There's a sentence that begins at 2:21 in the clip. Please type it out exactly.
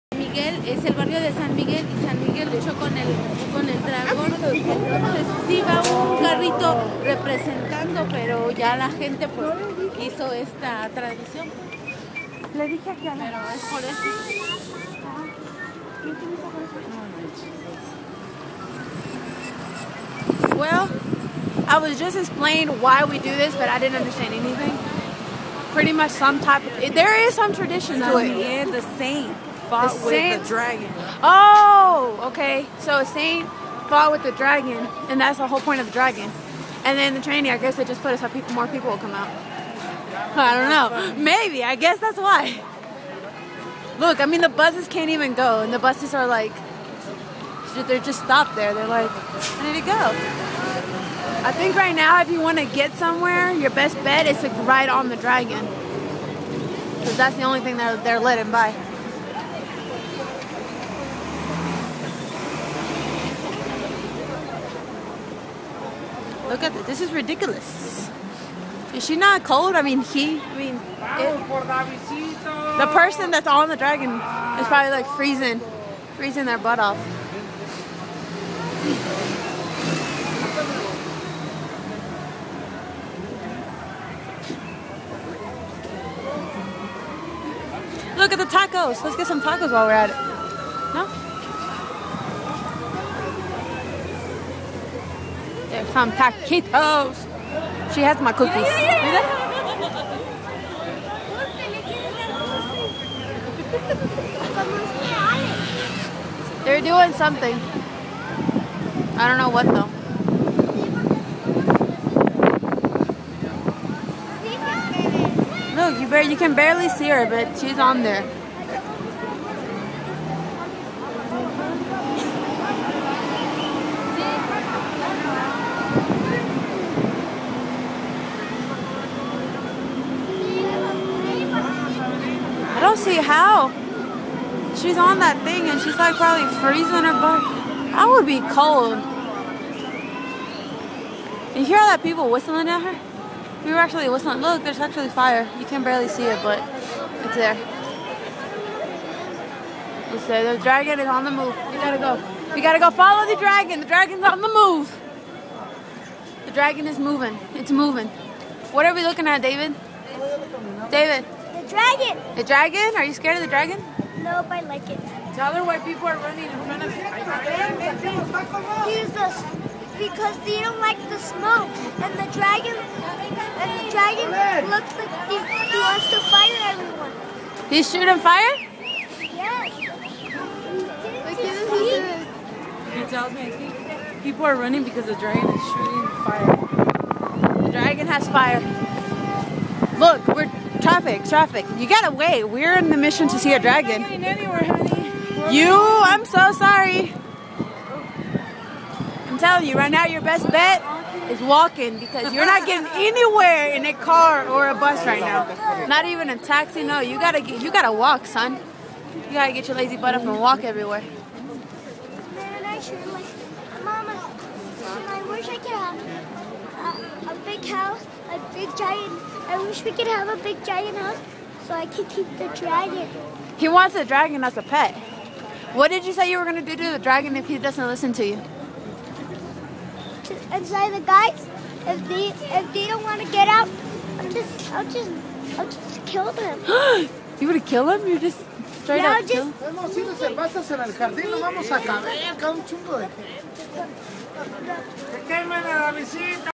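You hear all that people whistling at her?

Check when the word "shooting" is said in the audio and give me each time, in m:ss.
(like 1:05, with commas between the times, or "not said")
2:57, 3:05.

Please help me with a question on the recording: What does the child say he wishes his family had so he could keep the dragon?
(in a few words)
A big giant house.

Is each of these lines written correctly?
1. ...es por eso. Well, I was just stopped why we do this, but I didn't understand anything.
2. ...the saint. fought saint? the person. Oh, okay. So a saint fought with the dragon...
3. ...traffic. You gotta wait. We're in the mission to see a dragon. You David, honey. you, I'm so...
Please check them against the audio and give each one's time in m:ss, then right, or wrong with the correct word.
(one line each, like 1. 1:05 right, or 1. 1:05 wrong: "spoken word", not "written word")
1. 0:13 wrong: "explained", not "stopped"
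2. 0:28 wrong: "dragon", not "person"
3. 3:11 wrong: "Anywhere", not "David".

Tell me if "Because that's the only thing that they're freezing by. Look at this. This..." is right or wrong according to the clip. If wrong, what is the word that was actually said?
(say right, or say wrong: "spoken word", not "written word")
wrong: "letting", not "freezing".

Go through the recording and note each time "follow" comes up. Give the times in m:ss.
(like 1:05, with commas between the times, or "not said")
2:32.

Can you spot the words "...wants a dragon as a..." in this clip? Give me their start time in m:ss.
3:43.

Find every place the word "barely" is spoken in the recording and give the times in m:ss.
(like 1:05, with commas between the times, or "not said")
1:56, 2:25.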